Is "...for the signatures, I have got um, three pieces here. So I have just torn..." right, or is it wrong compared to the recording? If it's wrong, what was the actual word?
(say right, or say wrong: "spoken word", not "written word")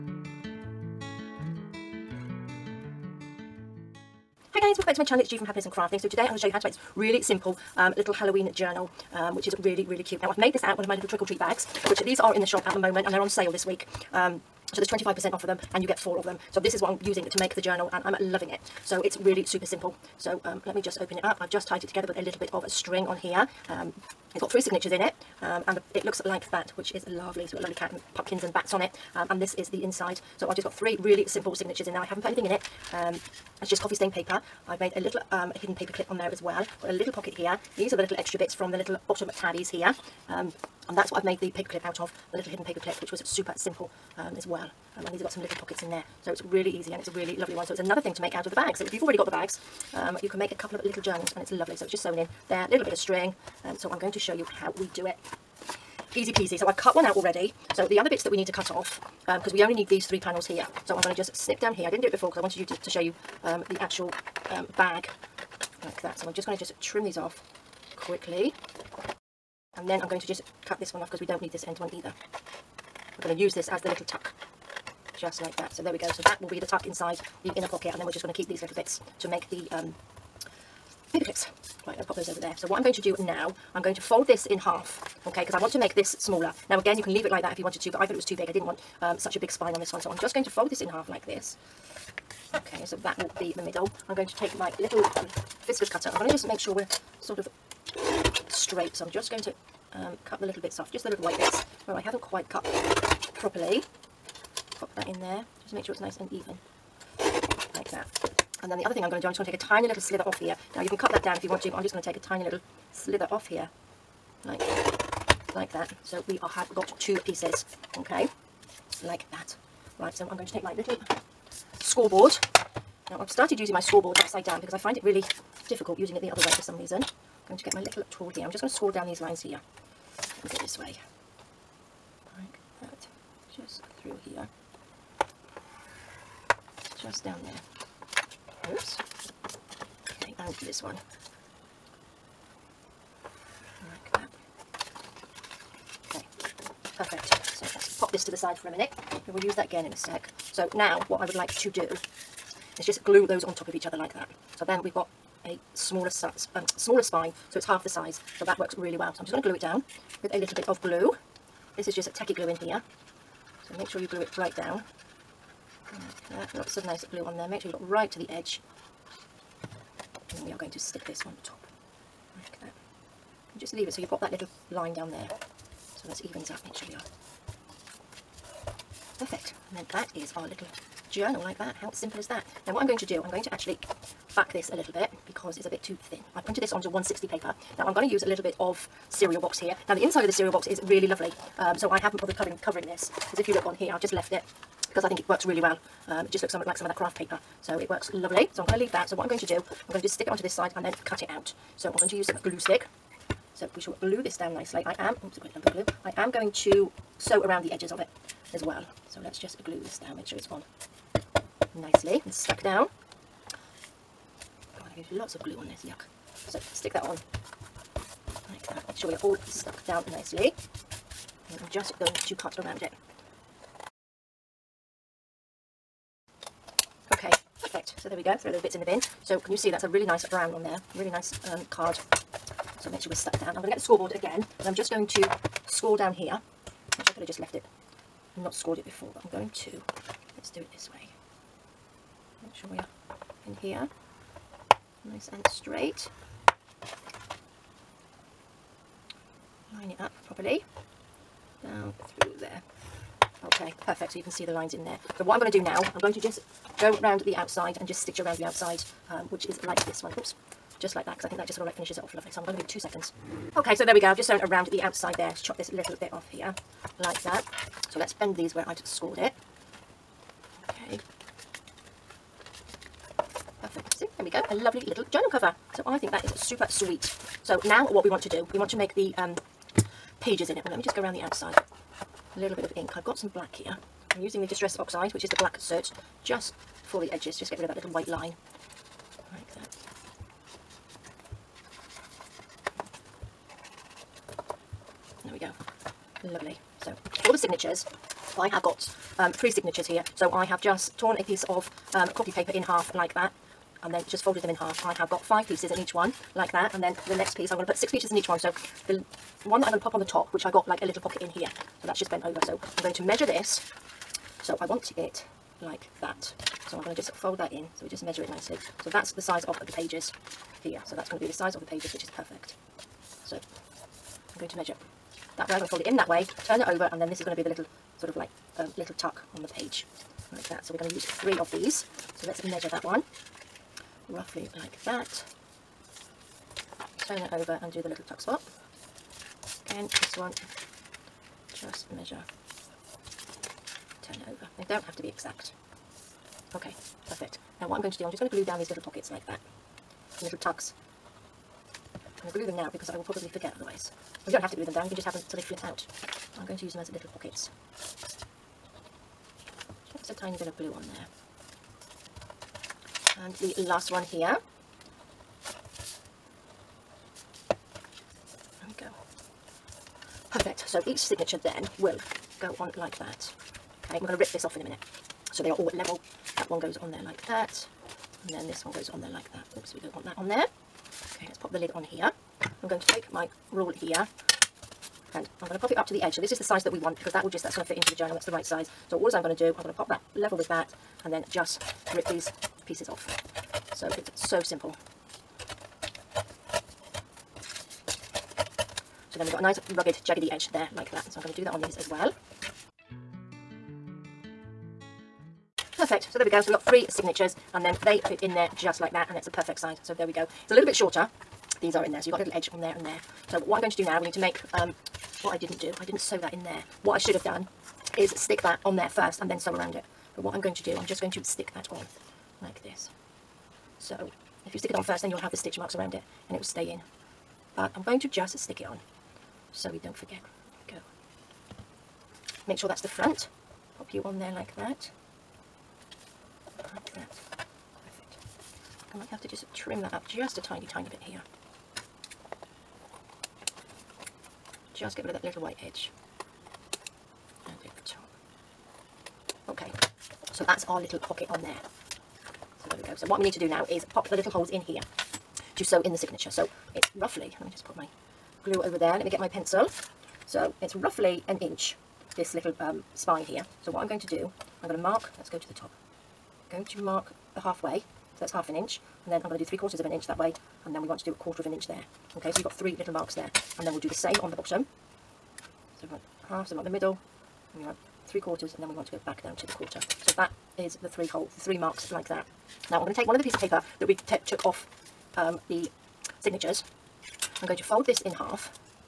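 wrong: "signatures", not "pieces".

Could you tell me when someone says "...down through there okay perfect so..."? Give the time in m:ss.
4:11.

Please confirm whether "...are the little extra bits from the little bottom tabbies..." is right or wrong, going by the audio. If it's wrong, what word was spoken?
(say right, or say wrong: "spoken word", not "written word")
right.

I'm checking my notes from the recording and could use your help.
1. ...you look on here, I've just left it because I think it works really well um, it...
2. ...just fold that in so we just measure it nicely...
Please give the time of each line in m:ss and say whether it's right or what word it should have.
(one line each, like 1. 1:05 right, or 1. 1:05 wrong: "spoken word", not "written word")
1. 3:13 right
2. 5:16 right.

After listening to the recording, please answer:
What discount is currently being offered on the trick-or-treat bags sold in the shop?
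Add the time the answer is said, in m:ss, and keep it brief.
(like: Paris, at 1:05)
25%, at 0:14.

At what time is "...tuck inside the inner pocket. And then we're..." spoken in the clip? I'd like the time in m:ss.
1:16.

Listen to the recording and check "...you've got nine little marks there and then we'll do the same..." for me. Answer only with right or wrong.
wrong.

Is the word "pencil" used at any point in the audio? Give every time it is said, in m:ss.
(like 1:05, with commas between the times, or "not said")
7:39.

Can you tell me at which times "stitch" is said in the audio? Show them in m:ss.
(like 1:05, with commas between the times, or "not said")
4:18, 7:05.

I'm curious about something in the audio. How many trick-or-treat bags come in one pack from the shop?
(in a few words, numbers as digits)
4.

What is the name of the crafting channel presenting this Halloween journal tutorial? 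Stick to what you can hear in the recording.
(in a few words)
Happiness in Crafting.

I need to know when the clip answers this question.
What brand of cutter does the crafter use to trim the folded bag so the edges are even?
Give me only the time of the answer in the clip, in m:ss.
1:35.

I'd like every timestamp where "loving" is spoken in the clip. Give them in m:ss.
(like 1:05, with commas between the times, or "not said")
0:18.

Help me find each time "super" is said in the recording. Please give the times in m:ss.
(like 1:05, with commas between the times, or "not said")
0:19, 0:43, 4:36.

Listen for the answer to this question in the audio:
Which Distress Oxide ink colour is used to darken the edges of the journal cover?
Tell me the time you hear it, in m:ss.
4:45.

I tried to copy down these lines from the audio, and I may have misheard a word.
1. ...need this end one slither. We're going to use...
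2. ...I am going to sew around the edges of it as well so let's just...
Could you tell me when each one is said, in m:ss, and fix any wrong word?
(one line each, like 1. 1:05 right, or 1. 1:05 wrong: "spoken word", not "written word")
1. 1:11 wrong: "either", not "slither"
2. 3:26 right.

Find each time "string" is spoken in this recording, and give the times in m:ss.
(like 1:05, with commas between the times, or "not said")
0:22, 0:52.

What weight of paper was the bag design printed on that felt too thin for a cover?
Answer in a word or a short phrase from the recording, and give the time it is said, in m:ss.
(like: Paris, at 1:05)
160, at 3:06.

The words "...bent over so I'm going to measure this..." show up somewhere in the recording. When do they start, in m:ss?
5:12.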